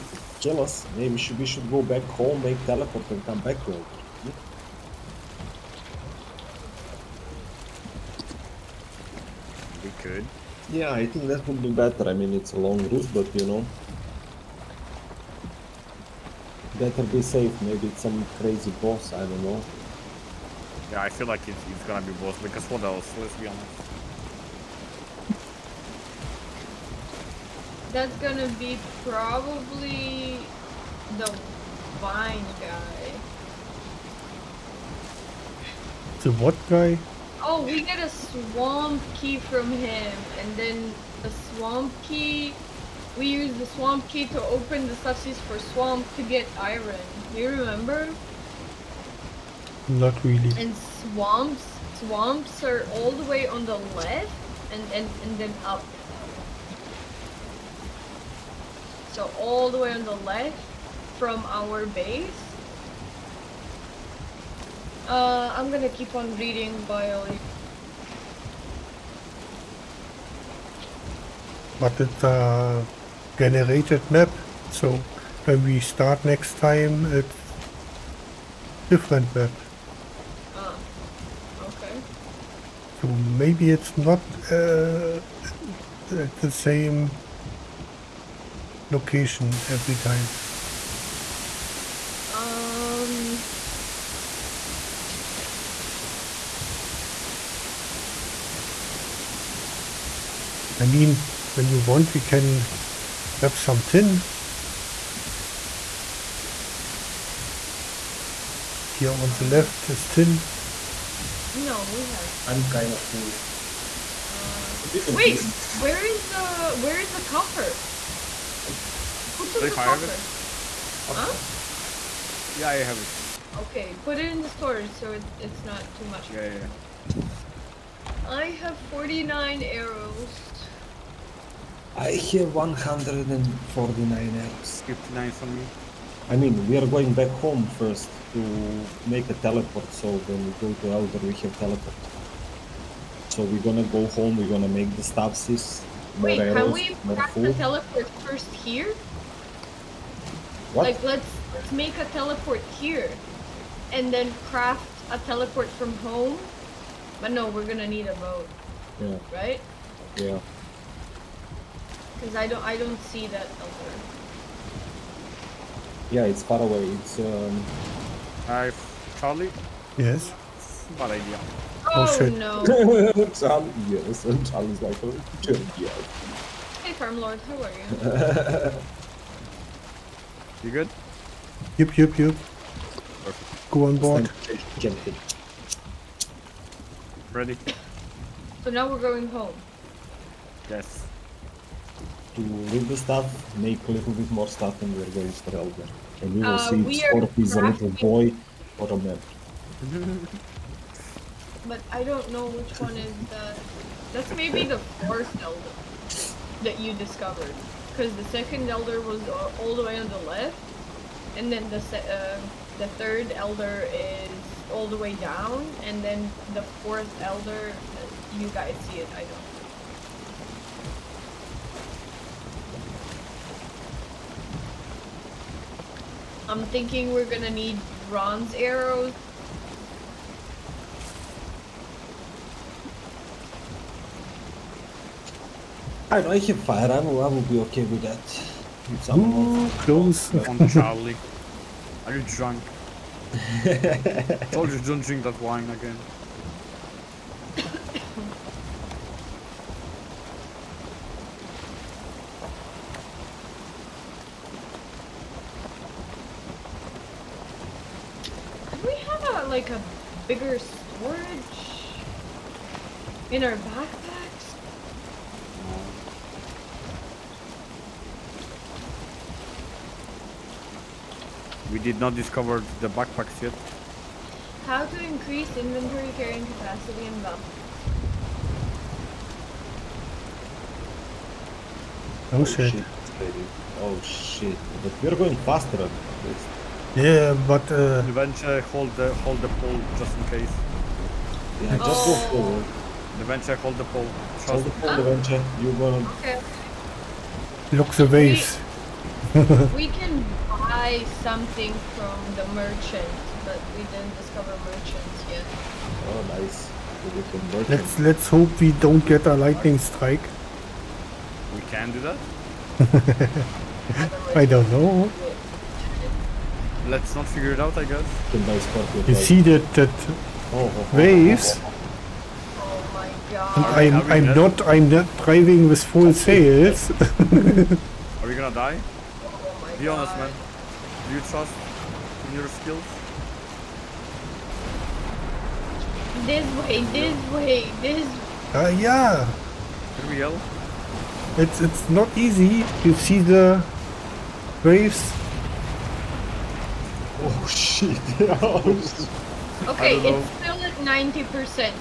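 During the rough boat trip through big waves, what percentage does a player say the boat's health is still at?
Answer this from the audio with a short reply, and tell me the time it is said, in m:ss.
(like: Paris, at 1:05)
90%, at 5:50.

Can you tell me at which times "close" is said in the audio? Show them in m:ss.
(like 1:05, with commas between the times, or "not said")
3:59.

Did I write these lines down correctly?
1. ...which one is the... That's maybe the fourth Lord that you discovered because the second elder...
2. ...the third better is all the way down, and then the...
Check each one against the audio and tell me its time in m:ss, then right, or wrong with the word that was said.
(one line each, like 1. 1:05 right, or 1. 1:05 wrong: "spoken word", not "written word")
1. 3:22 wrong: "Elder", not "Lord"
2. 3:32 wrong: "elder", not "better".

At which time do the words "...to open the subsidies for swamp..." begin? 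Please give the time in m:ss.
0:44.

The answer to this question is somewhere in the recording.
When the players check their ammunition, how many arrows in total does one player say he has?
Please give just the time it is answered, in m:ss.
2:12.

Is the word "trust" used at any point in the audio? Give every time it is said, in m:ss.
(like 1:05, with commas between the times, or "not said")
4:54, 5:31.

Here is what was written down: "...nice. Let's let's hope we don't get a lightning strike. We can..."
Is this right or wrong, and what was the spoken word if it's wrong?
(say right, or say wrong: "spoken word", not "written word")
right.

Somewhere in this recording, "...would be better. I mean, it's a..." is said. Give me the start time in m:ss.
0:11.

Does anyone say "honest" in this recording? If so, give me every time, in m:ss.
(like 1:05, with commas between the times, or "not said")
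0:23, 5:29.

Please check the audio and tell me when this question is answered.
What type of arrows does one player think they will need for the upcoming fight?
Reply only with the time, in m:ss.
3:48.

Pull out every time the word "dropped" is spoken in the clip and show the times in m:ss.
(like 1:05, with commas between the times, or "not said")
not said.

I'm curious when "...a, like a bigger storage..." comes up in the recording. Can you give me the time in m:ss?
4:19.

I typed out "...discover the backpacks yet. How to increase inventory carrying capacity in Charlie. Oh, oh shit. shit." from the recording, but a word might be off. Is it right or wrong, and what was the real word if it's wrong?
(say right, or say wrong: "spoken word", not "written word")
wrong: "Valheim", not "Charlie".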